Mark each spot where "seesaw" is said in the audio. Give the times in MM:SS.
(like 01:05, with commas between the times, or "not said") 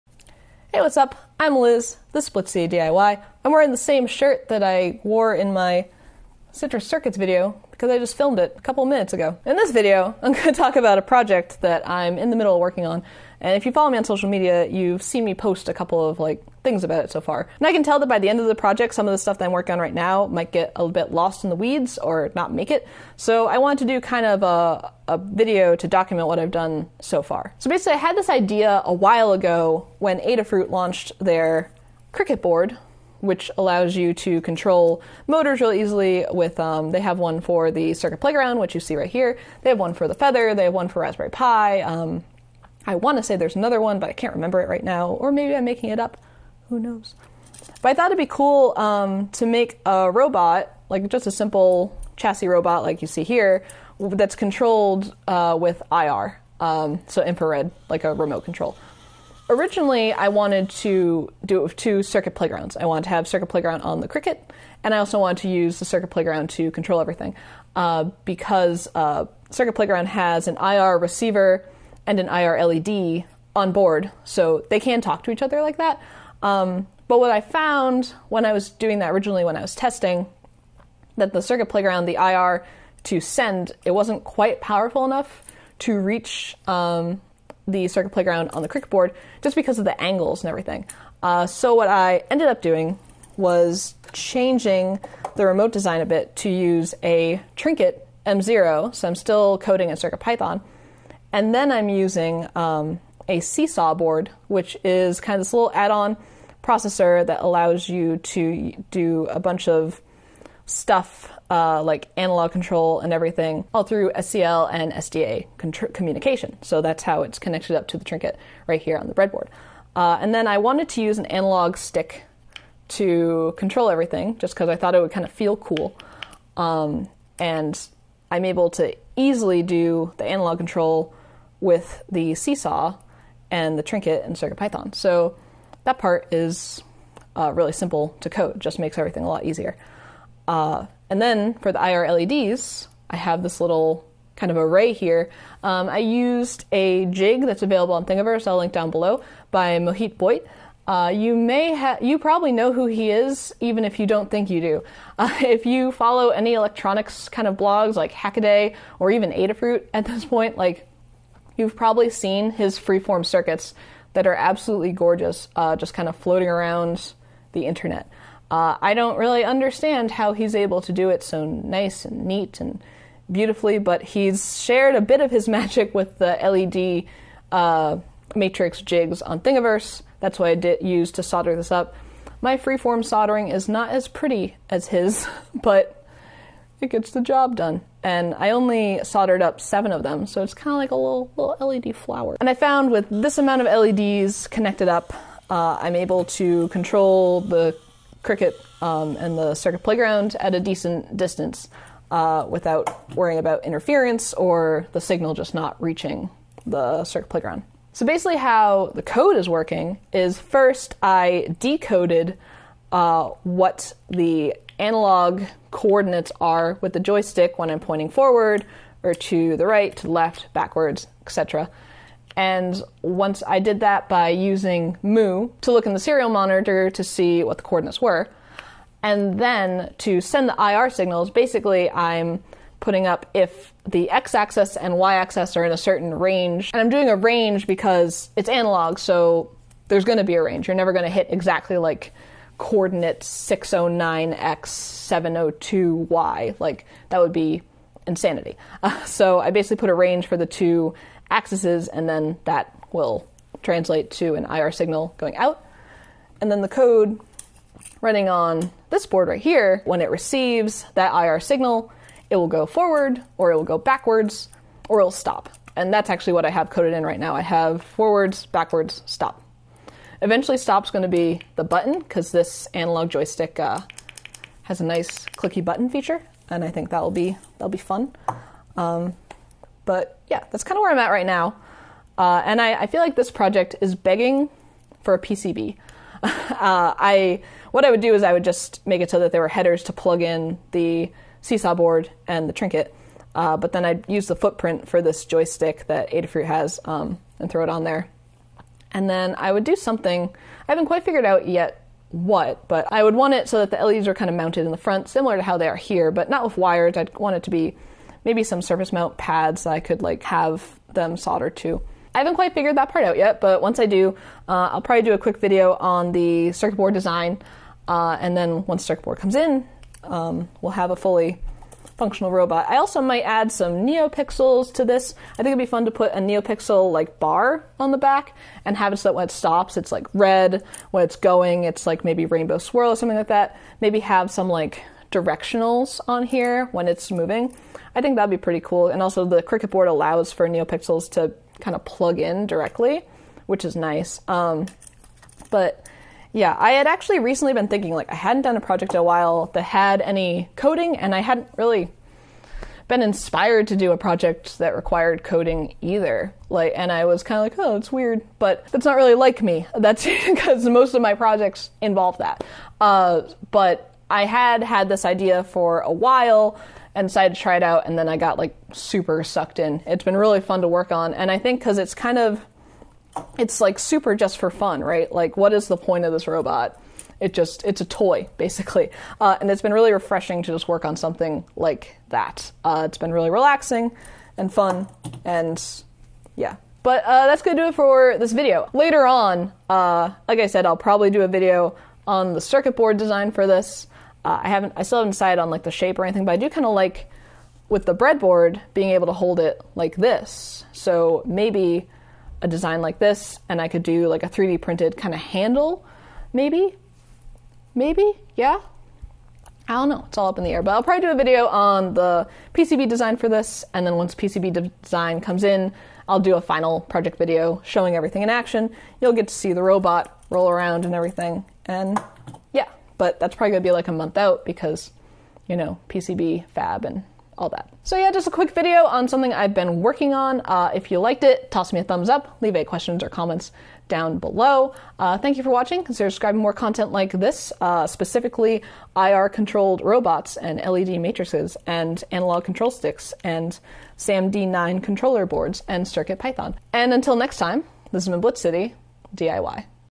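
01:43, 02:12, 04:51.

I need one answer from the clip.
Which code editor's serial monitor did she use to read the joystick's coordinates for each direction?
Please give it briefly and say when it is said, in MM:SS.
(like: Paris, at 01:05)
Mu, at 03:45.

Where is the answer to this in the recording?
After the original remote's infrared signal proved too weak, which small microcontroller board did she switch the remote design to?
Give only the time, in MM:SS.
01:37.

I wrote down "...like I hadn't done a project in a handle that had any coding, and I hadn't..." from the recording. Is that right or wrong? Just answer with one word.
wrong.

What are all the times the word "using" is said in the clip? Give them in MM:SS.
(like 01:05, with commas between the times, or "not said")
01:41, 03:44.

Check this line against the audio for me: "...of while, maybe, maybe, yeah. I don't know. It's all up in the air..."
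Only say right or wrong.
wrong.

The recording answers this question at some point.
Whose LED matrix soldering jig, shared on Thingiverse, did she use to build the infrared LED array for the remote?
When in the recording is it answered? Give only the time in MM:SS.
02:29.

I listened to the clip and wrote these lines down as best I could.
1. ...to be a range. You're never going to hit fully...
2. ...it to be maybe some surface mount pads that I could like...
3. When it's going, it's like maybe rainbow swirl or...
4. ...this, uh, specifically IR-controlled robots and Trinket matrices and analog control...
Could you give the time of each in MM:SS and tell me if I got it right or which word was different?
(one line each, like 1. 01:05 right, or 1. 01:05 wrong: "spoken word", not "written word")
1. 04:00 wrong: "exactly", not "fully"
2. 05:07 right
3. 05:30 right
4. 07:17 wrong: "LED", not "Trinket".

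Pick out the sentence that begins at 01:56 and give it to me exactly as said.
So that's how it's connected up to the trinket right here on the breadboard.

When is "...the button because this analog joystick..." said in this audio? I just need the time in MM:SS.
04:31.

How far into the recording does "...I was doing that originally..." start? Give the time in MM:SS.
01:18.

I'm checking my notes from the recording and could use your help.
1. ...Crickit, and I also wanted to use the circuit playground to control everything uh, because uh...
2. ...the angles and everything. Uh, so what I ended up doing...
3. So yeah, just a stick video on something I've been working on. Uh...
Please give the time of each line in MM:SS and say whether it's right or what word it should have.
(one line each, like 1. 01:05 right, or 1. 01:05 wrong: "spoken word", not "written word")
1. 01:04 right
2. 01:29 right
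3. 07:07 wrong: "quick", not "stick".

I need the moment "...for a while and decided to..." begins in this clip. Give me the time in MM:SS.
06:05.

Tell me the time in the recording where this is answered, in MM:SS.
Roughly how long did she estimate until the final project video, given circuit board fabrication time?
07:03.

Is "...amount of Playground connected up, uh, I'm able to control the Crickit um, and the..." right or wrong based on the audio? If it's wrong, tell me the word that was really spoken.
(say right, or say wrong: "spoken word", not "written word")
wrong: "LEDs", not "Playground".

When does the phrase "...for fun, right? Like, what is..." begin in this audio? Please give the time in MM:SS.
06:14.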